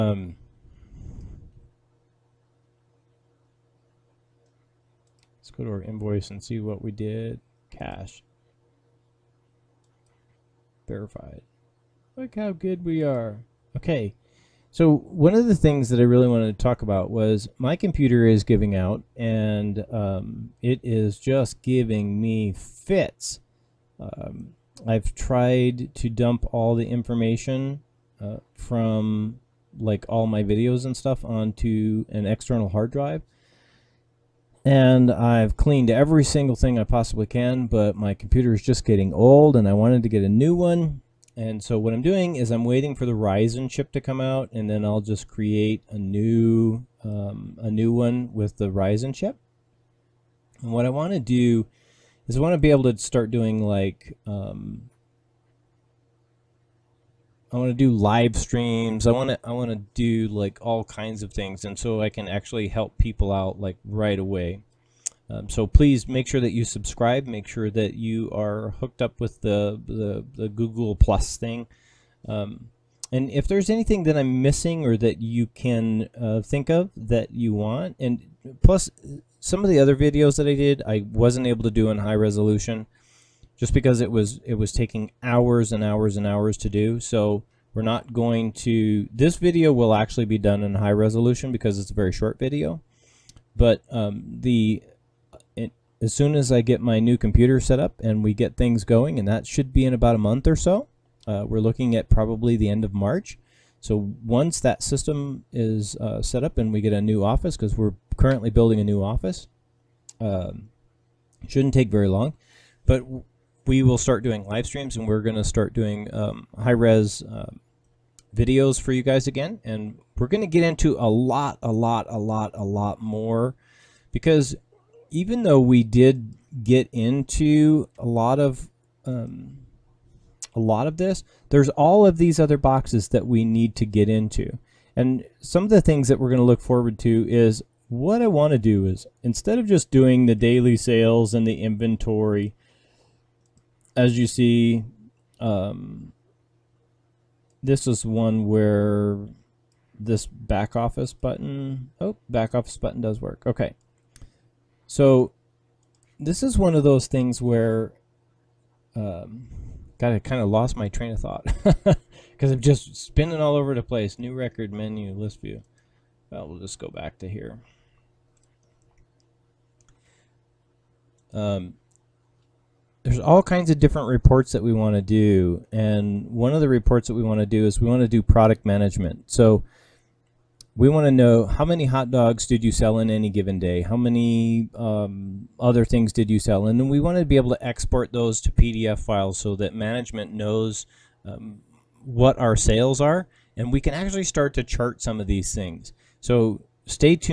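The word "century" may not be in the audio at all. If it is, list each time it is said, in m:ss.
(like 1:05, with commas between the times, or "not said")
not said.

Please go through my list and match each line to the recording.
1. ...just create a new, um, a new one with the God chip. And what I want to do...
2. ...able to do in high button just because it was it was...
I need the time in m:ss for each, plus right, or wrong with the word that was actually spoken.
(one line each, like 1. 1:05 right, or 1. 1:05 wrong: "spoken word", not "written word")
1. 0:44 wrong: "Ryzen", not "God"
2. 1:21 wrong: "resolution", not "button".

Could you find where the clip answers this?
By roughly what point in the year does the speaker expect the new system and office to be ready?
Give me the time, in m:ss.
1:42.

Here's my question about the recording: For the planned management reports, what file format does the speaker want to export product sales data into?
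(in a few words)
PDF.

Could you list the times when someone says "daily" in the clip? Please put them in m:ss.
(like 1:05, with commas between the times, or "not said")
2:20.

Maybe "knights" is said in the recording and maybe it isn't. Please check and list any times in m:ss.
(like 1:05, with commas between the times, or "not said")
not said.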